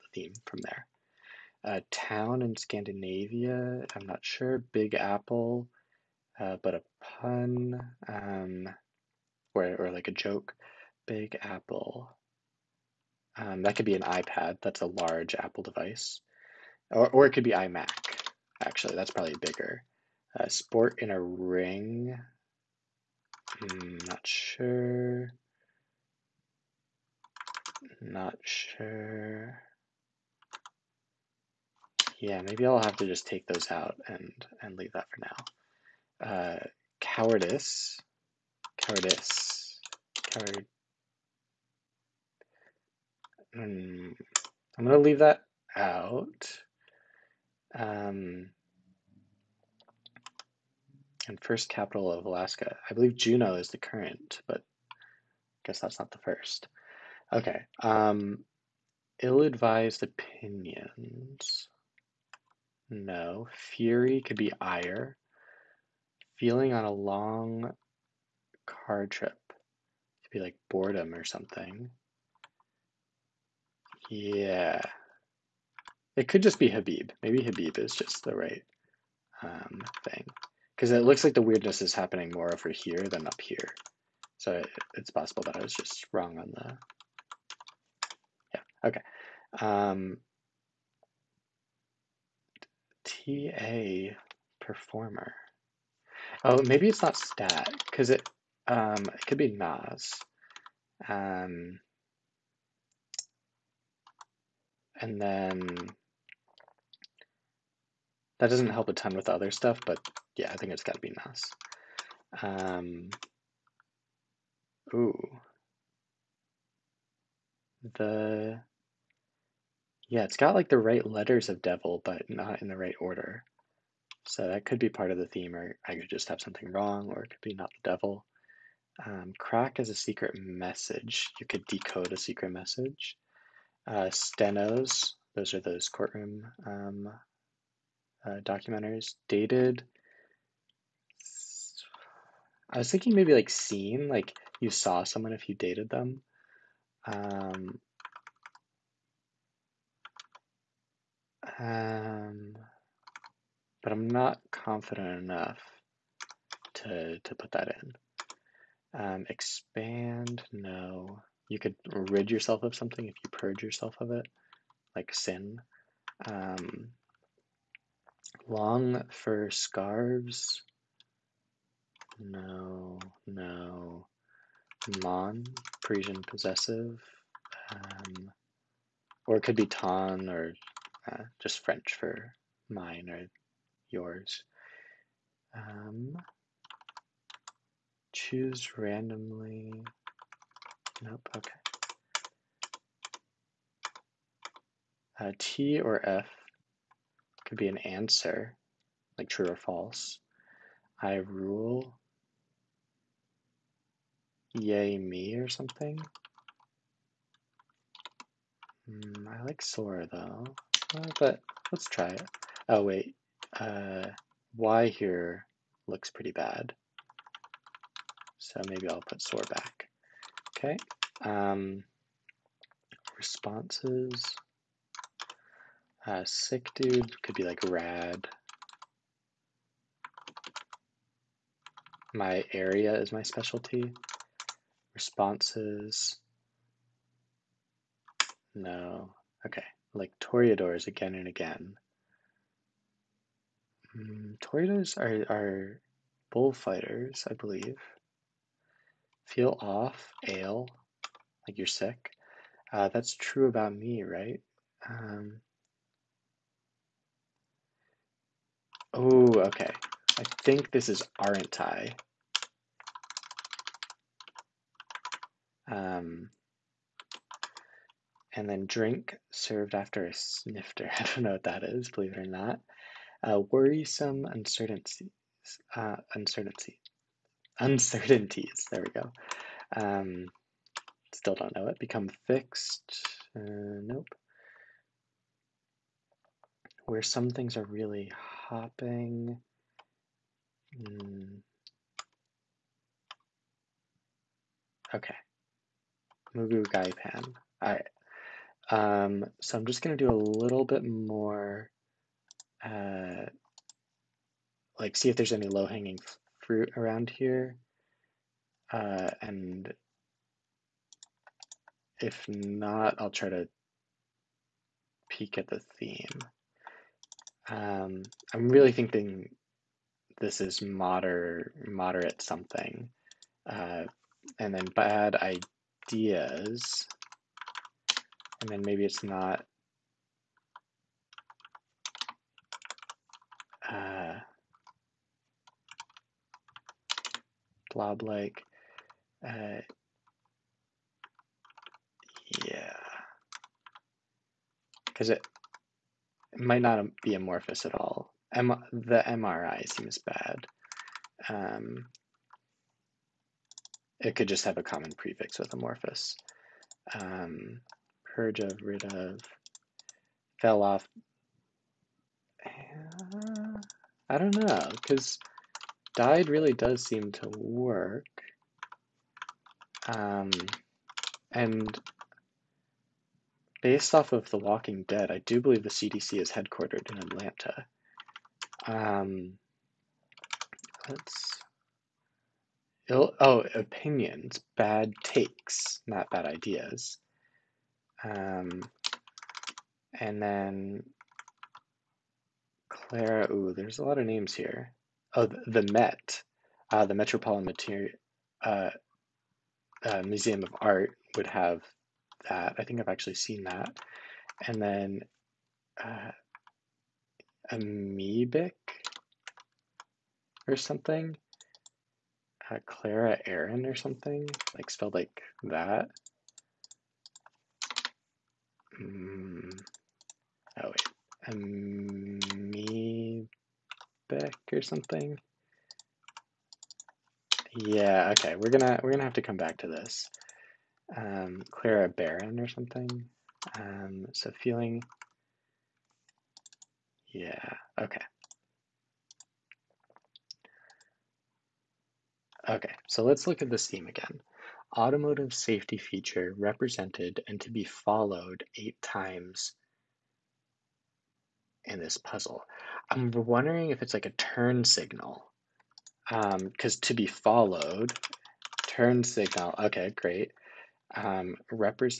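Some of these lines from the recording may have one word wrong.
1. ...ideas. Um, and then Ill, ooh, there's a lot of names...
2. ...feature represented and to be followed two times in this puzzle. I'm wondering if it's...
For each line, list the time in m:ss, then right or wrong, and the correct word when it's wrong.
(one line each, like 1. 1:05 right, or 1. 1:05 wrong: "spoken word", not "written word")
1. 6:26 wrong: "Clara", not "Ill"
2. 7:25 wrong: "eight", not "two".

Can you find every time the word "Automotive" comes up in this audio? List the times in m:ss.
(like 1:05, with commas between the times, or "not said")
7:24.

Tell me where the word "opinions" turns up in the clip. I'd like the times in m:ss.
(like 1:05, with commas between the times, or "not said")
1:00, 6:23.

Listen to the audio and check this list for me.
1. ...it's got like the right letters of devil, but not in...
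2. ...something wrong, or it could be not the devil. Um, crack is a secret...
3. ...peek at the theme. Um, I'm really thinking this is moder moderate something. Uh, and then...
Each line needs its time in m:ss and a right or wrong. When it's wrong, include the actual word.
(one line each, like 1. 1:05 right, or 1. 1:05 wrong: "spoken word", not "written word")
1. 2:00 right
2. 2:06 right
3. 5:15 right.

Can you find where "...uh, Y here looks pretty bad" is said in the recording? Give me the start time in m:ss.
3:33.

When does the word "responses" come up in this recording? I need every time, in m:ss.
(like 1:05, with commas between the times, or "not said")
3:43, 3:54.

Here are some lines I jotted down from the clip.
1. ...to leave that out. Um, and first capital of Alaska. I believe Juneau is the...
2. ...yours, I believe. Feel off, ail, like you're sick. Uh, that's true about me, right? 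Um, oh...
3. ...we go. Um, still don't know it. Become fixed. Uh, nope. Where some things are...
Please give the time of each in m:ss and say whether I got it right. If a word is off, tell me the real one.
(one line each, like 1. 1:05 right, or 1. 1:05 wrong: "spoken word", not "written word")
1. 0:44 right
2. 4:06 wrong: "bullfighters", not "yours"
3. 4:38 right.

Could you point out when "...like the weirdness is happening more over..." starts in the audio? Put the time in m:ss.
1:21.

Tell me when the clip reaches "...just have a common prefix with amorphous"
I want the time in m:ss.
5:54.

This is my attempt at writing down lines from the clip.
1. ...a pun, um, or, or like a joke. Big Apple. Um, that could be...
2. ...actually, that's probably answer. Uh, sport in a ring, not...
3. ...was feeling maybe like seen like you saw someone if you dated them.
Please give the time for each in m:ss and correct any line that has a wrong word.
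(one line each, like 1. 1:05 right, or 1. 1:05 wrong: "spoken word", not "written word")
1. 0:06 right
2. 0:18 wrong: "bigger", not "answer"
3. 2:22 wrong: "thinking", not "feeling".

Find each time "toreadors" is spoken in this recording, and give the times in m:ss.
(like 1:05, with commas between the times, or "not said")
4:00, 4:04.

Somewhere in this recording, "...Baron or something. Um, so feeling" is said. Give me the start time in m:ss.
7:11.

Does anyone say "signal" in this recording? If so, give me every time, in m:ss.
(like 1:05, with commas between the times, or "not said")
7:34, 7:39.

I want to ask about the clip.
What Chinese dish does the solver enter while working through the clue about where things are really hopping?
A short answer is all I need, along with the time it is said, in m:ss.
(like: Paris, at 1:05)
Moo goo gai pan, at 4:56.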